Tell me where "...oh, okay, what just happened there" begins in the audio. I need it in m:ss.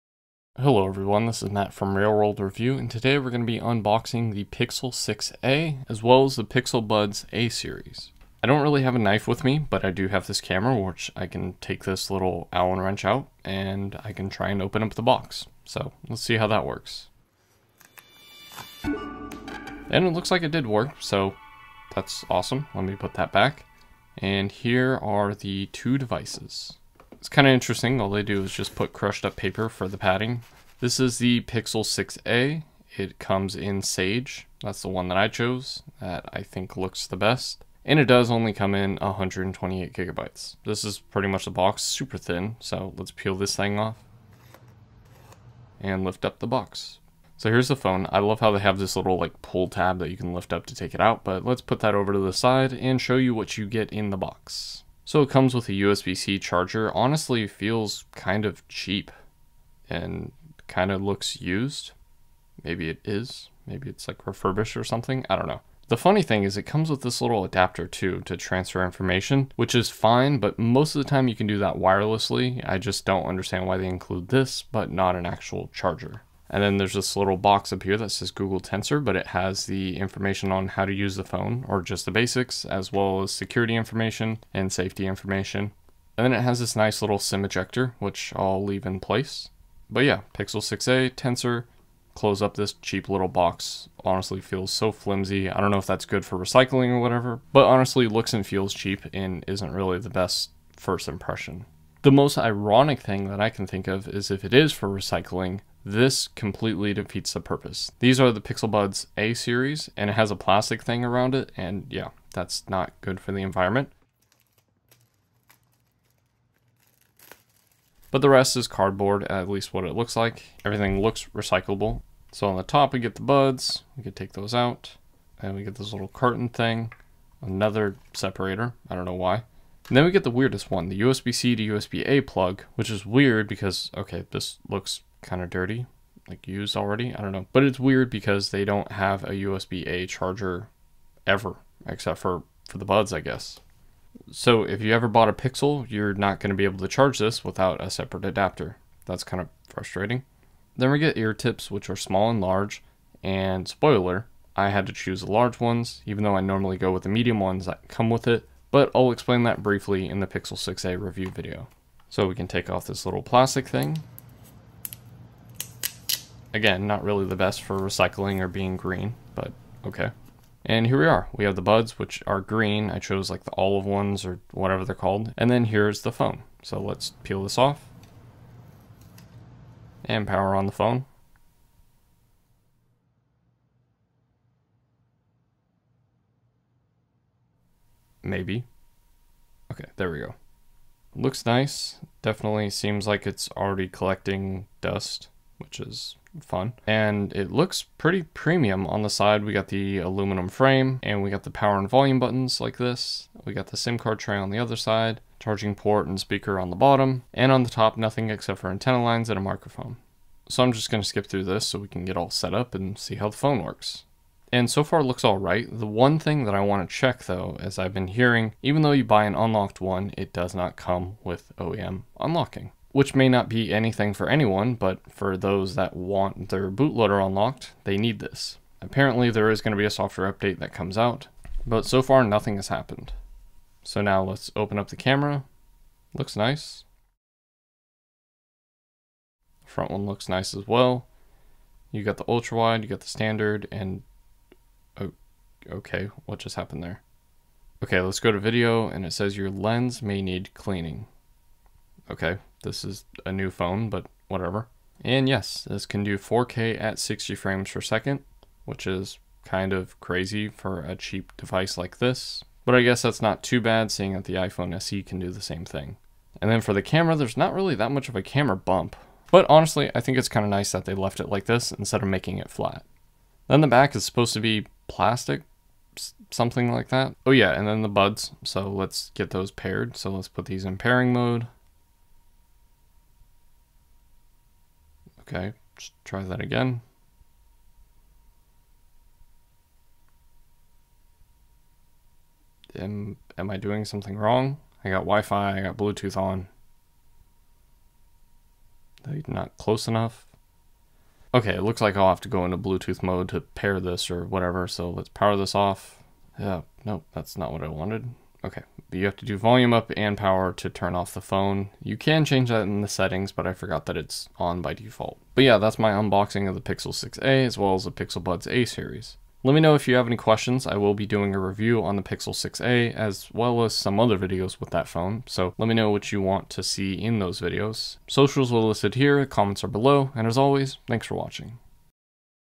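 4:04.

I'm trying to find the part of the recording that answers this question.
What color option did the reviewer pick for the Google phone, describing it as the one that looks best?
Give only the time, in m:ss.
0:33.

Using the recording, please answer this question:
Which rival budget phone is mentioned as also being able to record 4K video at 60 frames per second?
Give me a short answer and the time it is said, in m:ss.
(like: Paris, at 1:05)
iPhone SE, at 4:24.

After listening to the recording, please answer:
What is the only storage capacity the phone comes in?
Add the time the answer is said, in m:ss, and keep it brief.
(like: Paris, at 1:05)
128 gigabytes, at 0:38.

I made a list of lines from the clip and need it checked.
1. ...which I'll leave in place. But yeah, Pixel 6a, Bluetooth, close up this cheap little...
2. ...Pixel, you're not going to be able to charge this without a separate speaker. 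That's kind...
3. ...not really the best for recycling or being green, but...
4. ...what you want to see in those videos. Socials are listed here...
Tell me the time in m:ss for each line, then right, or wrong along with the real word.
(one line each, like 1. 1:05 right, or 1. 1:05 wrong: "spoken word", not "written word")
1. 1:27 wrong: "Tensor", not "Bluetooth"
2. 2:25 wrong: "adapter", not "speaker"
3. 2:46 right
4. 5:25 right.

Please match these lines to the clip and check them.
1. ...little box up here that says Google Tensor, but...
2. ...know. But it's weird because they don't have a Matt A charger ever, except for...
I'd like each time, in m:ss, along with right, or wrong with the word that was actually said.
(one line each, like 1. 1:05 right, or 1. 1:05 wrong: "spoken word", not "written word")
1. 1:17 right
2. 2:17 wrong: "USB", not "Matt".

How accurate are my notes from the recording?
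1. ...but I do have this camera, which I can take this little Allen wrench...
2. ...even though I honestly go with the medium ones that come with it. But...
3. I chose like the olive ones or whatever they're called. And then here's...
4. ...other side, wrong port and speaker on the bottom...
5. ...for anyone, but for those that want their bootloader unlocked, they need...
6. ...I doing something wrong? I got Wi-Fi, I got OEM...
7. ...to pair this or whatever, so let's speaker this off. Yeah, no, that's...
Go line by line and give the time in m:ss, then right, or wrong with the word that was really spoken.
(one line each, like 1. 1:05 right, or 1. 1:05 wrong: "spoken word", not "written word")
1. 0:09 right
2. 2:36 wrong: "normally", not "honestly"
3. 2:52 right
4. 3:24 wrong: "charging", not "wrong"
5. 3:44 right
6. 4:53 wrong: "Bluetooth", not "OEM"
7. 5:03 wrong: "power", not "speaker".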